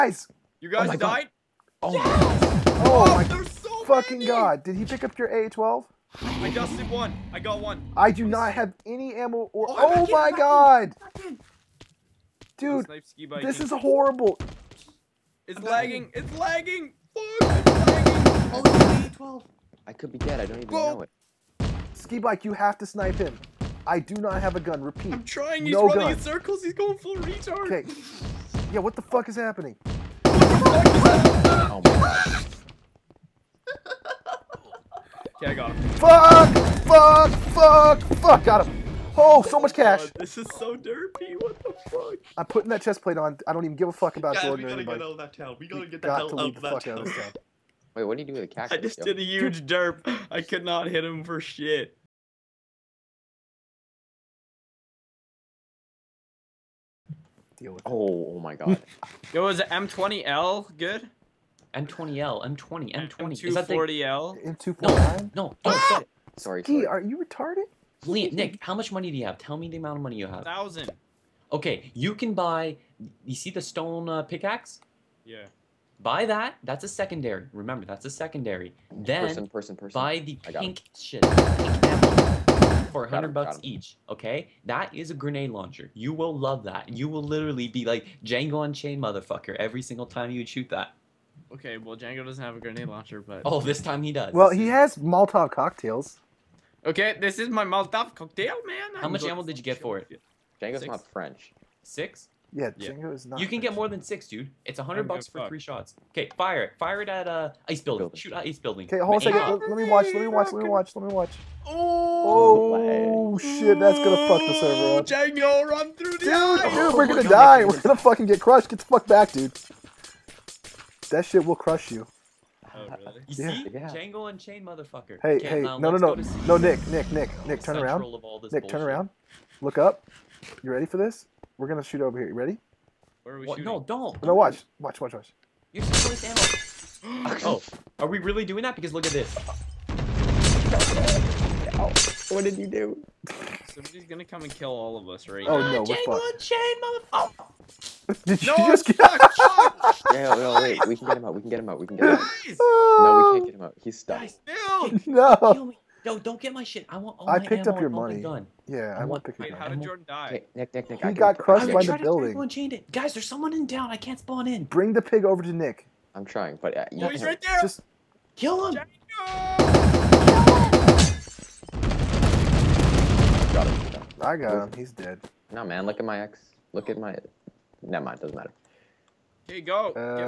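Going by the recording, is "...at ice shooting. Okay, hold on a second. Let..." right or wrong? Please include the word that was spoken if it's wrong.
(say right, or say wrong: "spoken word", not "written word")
wrong: "building", not "shooting".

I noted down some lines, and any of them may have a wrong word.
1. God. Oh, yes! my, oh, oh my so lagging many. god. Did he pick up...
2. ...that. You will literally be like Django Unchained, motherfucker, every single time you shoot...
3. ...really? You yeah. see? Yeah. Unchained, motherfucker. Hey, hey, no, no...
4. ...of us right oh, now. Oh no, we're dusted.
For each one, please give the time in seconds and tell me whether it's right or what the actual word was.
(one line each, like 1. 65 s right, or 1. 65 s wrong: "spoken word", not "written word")
1. 0 s wrong: "fucking", not "lagging"
2. 86 s right
3. 122 s right
4. 144 s wrong: "fucked", not "dusted".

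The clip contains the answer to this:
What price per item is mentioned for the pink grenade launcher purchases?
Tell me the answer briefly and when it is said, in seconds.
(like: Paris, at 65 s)
100 bucks, at 83 s.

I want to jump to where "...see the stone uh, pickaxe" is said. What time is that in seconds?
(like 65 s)
73 s.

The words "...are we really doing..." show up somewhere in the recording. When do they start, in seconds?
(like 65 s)
137 s.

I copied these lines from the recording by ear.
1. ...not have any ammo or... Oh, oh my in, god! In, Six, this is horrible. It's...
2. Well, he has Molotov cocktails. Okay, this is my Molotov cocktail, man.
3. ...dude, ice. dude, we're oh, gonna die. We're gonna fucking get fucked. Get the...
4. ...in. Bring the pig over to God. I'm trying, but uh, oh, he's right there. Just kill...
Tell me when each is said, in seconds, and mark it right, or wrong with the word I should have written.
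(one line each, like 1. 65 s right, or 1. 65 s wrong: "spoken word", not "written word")
1. 8 s wrong: "Dude", not "Six"
2. 94 s right
3. 116 s wrong: "crushed", not "fucked"
4. 164 s wrong: "Nick", not "God".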